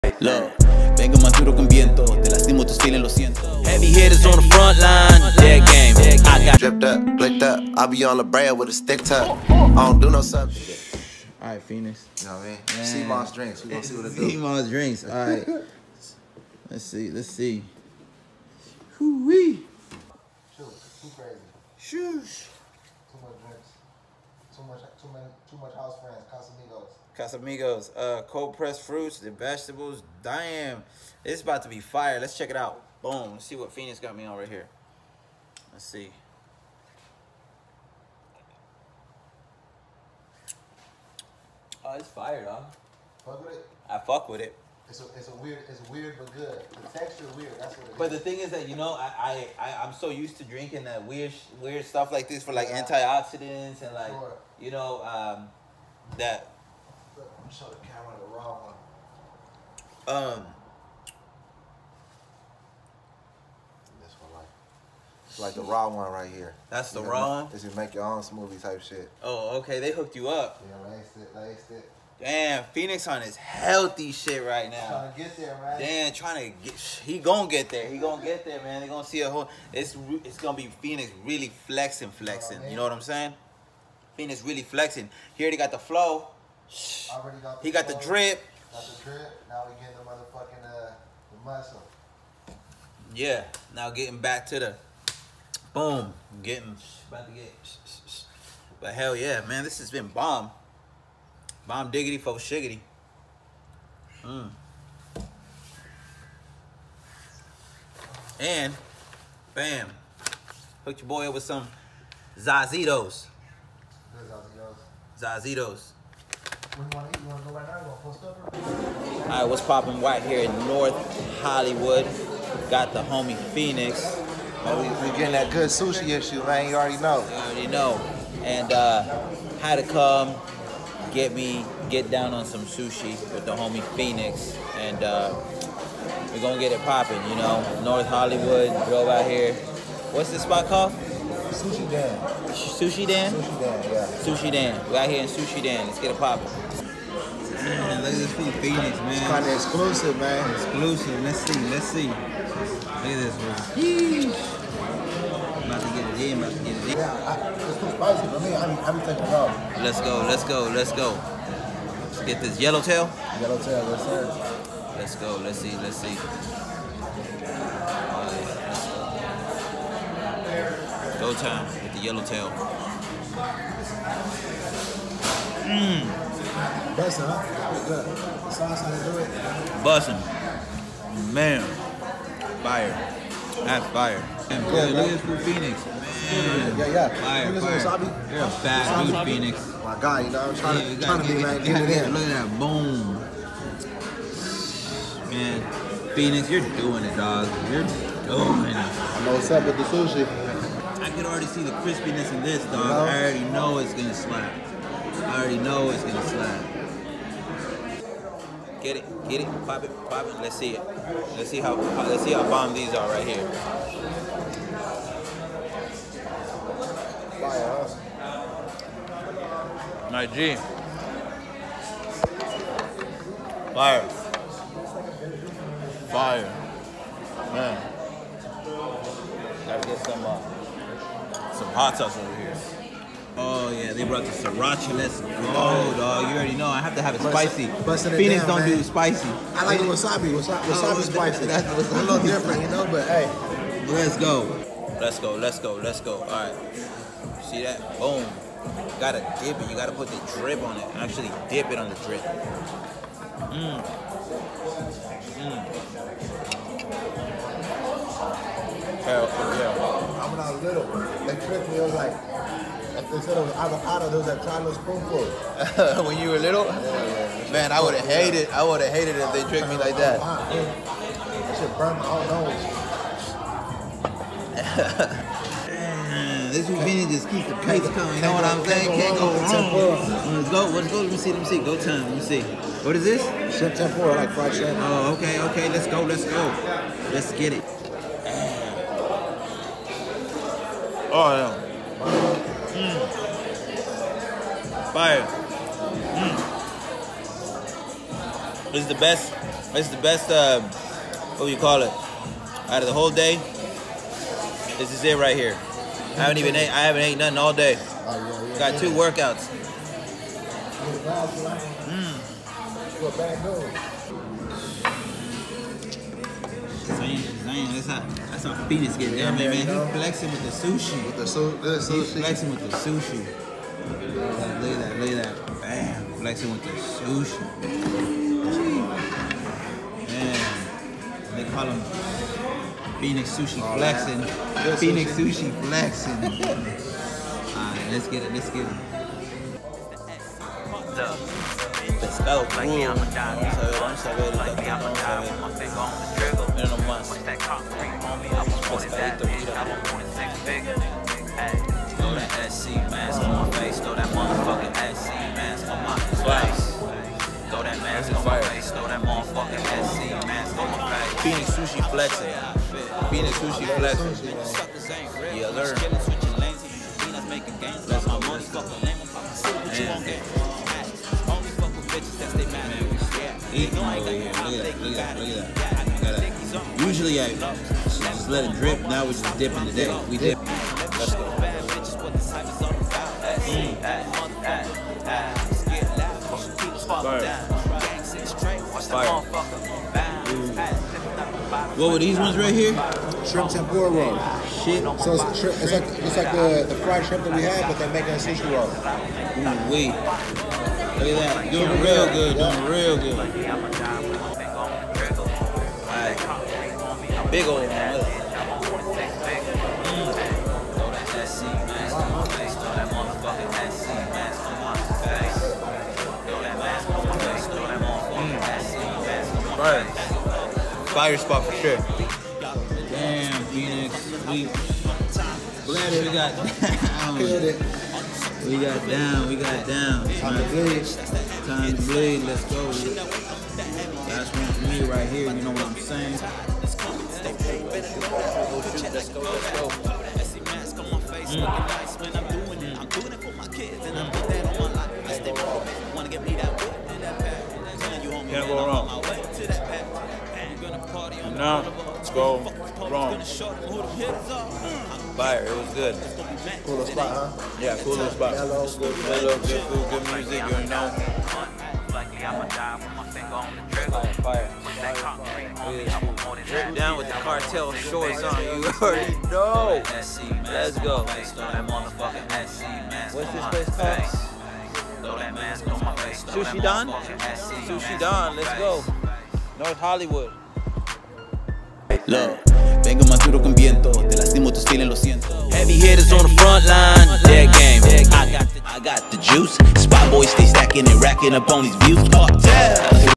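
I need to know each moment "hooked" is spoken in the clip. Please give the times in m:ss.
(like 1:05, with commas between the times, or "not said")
1:09, 1:50.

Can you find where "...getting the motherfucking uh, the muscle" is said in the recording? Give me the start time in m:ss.
1:29.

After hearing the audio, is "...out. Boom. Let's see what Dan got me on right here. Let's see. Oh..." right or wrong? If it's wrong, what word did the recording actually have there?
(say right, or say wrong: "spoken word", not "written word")
wrong: "Fenix", not "Dan".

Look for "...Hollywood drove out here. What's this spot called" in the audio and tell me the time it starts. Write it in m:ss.
2:18.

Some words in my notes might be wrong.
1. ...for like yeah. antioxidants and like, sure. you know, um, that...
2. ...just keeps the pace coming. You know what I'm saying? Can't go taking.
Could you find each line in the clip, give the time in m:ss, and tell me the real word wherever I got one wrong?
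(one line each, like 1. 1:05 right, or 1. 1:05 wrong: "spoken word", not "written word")
1. 0:52 right
2. 4:37 wrong: "wrong", not "taking".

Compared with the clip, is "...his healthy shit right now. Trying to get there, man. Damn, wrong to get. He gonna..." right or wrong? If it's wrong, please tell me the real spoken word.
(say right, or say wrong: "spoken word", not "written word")
wrong: "trying", not "wrong".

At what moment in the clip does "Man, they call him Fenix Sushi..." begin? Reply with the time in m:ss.
5:30.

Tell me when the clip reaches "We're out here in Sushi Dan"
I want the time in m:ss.
2:24.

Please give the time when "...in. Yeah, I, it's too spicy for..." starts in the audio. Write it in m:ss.
2:36.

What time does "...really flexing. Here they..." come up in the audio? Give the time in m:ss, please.
1:24.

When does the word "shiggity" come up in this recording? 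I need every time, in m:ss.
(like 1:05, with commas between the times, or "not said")
1:42.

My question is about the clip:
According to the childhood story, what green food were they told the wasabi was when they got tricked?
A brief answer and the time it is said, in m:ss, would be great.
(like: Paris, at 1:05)
Avocado, at 4:22.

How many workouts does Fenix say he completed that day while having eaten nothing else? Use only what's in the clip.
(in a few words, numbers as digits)
2.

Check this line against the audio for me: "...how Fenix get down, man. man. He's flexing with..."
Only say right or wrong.
right.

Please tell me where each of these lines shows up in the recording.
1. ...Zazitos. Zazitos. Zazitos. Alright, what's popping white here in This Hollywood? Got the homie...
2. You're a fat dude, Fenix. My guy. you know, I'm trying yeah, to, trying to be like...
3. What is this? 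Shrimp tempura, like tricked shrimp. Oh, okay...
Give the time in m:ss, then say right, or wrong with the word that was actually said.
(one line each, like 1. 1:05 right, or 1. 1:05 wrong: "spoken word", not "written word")
1. 1:52 wrong: "North", not "This"
2. 3:08 right
3. 4:42 wrong: "fried", not "tricked".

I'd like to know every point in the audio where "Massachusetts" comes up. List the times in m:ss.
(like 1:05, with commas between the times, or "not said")
not said.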